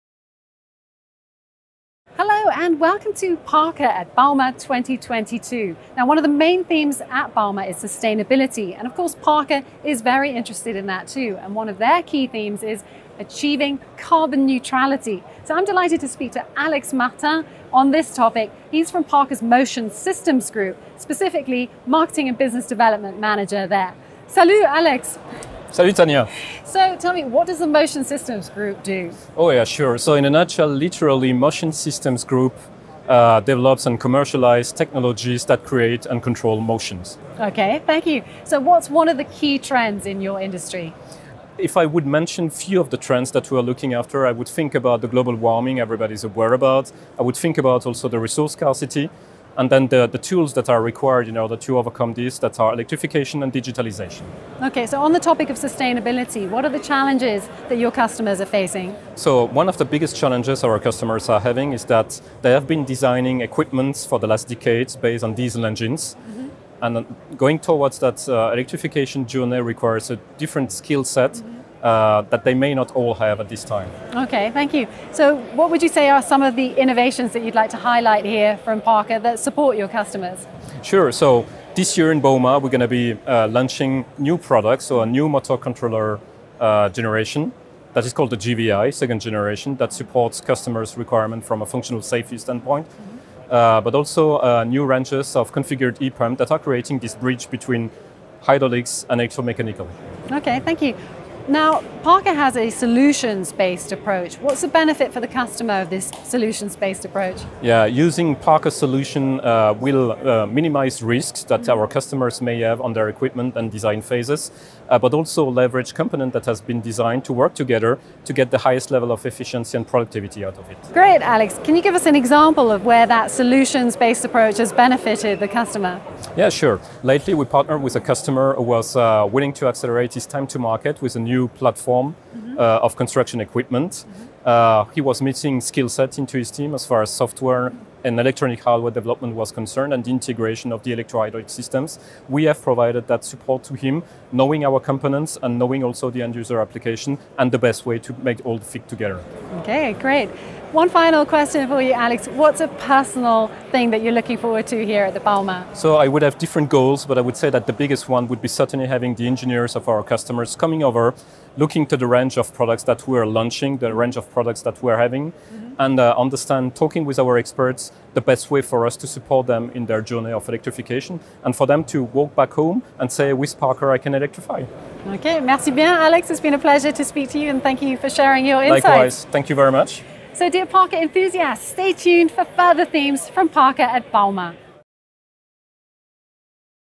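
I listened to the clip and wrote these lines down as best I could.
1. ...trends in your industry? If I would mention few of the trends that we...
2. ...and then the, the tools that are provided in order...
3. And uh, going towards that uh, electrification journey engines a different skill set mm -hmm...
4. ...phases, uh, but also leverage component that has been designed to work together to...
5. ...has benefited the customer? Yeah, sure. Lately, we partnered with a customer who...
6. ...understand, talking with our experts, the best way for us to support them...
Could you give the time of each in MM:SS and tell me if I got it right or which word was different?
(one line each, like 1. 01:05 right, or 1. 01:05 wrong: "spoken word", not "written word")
1. 00:39 right
2. 00:49 wrong: "required", not "provided"
3. 01:06 wrong: "requires", not "engines"
4. 01:54 right
5. 02:04 right
6. 02:46 right.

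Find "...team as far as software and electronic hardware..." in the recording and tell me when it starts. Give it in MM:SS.
02:16.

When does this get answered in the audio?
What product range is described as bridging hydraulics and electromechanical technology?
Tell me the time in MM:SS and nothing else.
01:35.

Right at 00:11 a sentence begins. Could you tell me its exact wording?
And one of their key themes is achieving carbon neutrality.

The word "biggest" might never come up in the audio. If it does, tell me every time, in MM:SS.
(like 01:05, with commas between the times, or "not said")
00:59, 02:37.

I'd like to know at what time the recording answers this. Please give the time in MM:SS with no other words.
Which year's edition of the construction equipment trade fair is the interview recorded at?
00:04.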